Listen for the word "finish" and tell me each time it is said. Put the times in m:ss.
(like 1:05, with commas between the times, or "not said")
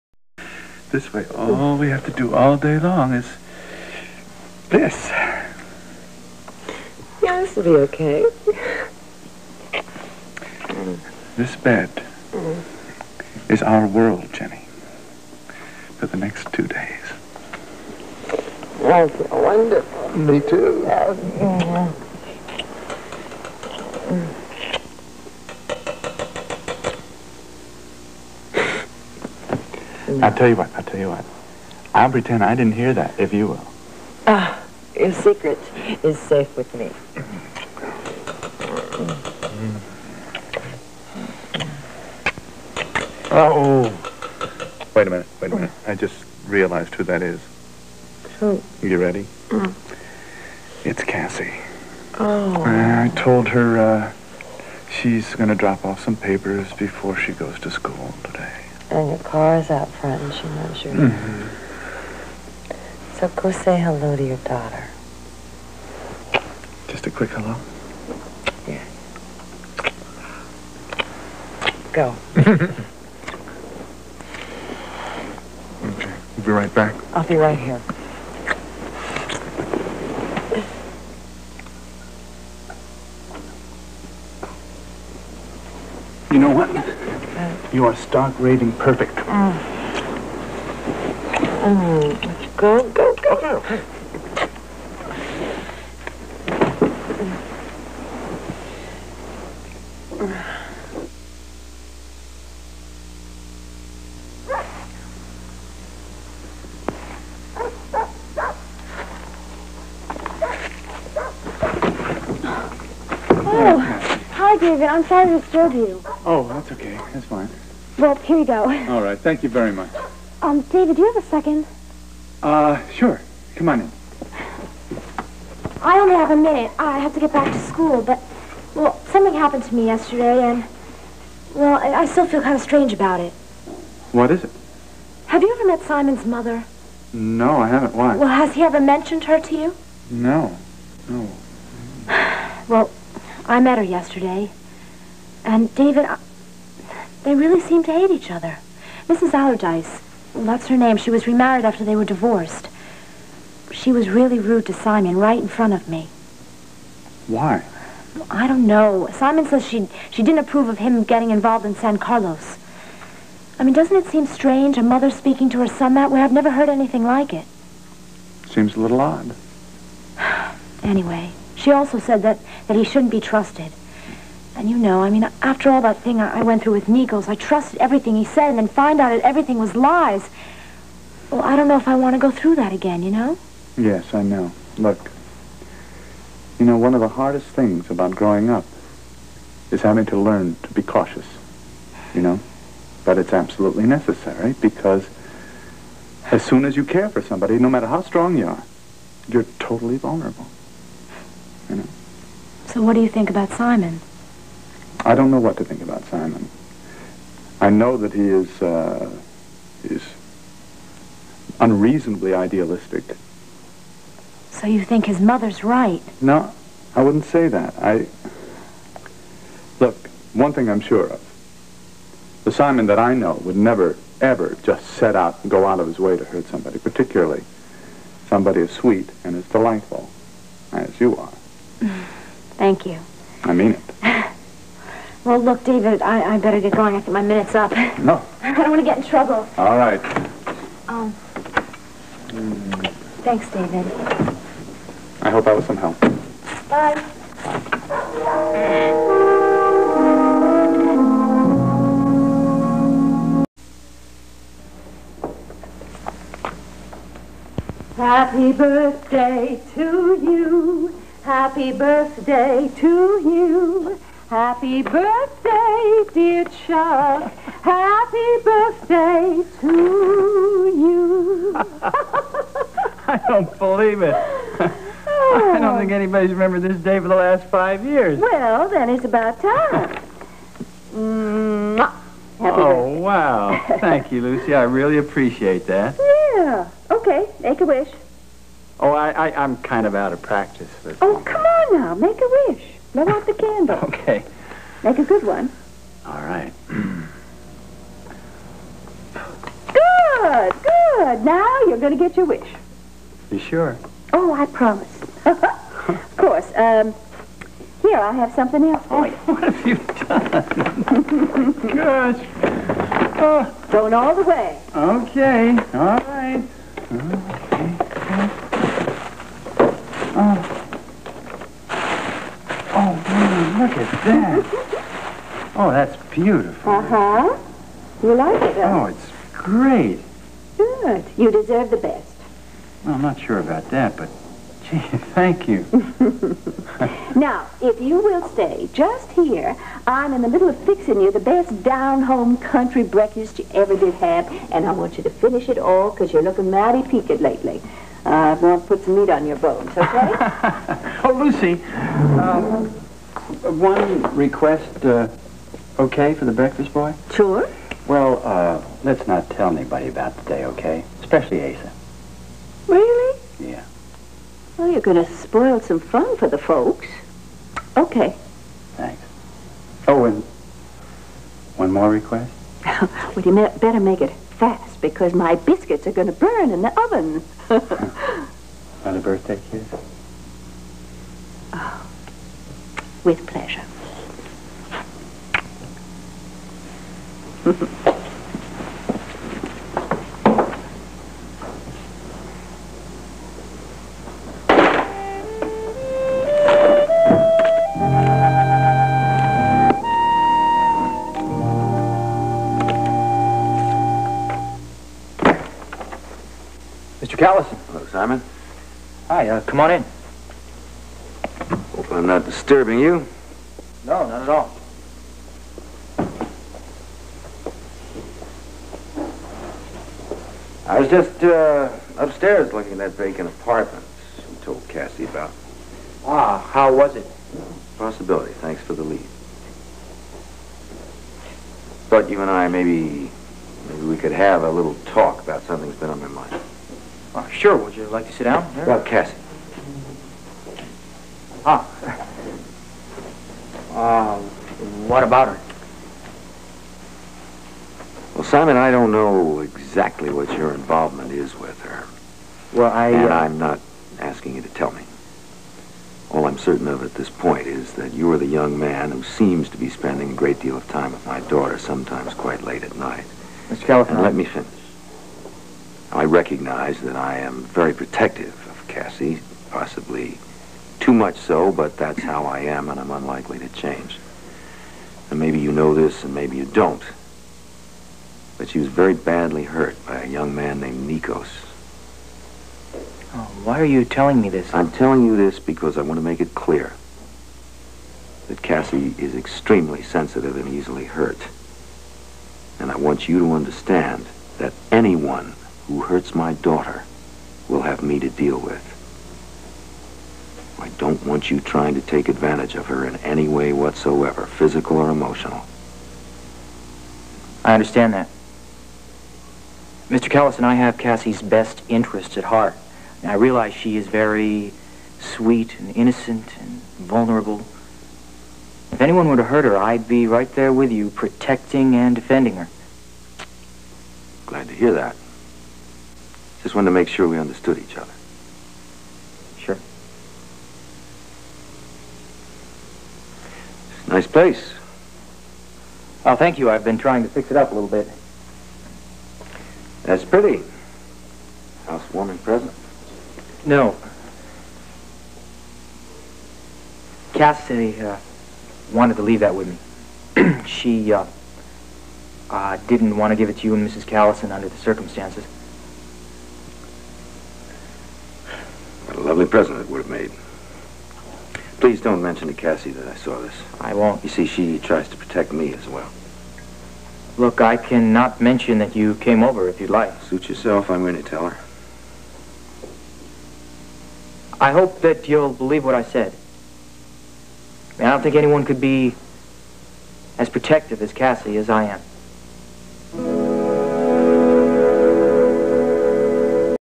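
5:45, 7:44.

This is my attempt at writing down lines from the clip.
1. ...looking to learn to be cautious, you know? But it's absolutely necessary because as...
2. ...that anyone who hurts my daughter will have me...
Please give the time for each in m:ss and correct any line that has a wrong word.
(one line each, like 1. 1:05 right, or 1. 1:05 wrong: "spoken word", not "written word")
1. 3:09 wrong: "having", not "looking"
2. 8:14 right.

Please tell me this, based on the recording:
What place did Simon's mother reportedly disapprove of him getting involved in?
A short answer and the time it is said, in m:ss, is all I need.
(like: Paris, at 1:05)
San Carlos, at 2:41.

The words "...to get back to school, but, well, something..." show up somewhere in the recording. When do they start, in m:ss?
2:07.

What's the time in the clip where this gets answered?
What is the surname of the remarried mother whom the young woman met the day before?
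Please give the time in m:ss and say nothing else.
2:29.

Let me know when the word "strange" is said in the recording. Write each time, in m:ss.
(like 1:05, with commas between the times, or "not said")
2:12, 2:44.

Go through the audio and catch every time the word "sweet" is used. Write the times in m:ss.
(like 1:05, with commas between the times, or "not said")
3:48, 8:34.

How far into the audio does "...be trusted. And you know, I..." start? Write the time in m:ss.
2:53.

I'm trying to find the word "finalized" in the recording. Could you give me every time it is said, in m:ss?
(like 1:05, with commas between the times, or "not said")
not said.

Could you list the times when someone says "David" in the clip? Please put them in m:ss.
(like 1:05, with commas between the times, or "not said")
1:54, 2:00, 2:25, 3:55, 4:03.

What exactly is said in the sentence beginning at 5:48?
Uh, i to put some meat on your bones, okay?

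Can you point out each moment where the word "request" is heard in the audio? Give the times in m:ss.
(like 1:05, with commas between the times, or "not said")
5:54, 6:11.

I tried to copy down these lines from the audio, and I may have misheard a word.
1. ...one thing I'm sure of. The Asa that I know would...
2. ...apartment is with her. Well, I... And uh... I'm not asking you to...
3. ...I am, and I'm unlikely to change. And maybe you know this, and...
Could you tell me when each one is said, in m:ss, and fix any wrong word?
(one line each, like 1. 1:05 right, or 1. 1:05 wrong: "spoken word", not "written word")
1. 3:40 wrong: "Simon", not "Asa"
2. 7:30 wrong: "involvement", not "apartment"
3. 7:52 right.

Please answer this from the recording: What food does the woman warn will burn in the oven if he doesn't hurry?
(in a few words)
biscuits.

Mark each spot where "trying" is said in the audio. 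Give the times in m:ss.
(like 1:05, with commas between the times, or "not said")
8:21, 8:56.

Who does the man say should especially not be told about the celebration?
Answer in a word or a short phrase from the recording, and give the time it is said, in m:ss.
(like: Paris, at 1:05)
Asa, at 6:01.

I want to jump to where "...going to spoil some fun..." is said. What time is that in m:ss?
6:04.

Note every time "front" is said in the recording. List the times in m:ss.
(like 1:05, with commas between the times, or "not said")
0:59, 2:35.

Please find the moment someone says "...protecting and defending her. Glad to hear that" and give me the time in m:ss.
8:40.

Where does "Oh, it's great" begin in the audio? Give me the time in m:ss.
5:28.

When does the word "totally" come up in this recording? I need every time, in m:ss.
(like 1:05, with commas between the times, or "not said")
3:19.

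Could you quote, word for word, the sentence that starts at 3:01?
Well, I don't know if I want to go through that again, you know?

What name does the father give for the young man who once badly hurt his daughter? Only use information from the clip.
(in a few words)
Nikos.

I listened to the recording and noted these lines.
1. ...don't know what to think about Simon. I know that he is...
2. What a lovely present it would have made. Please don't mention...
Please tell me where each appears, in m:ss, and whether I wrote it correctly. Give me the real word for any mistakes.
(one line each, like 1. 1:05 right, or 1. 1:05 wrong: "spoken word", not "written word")
1. 3:25 right
2. 9:18 right.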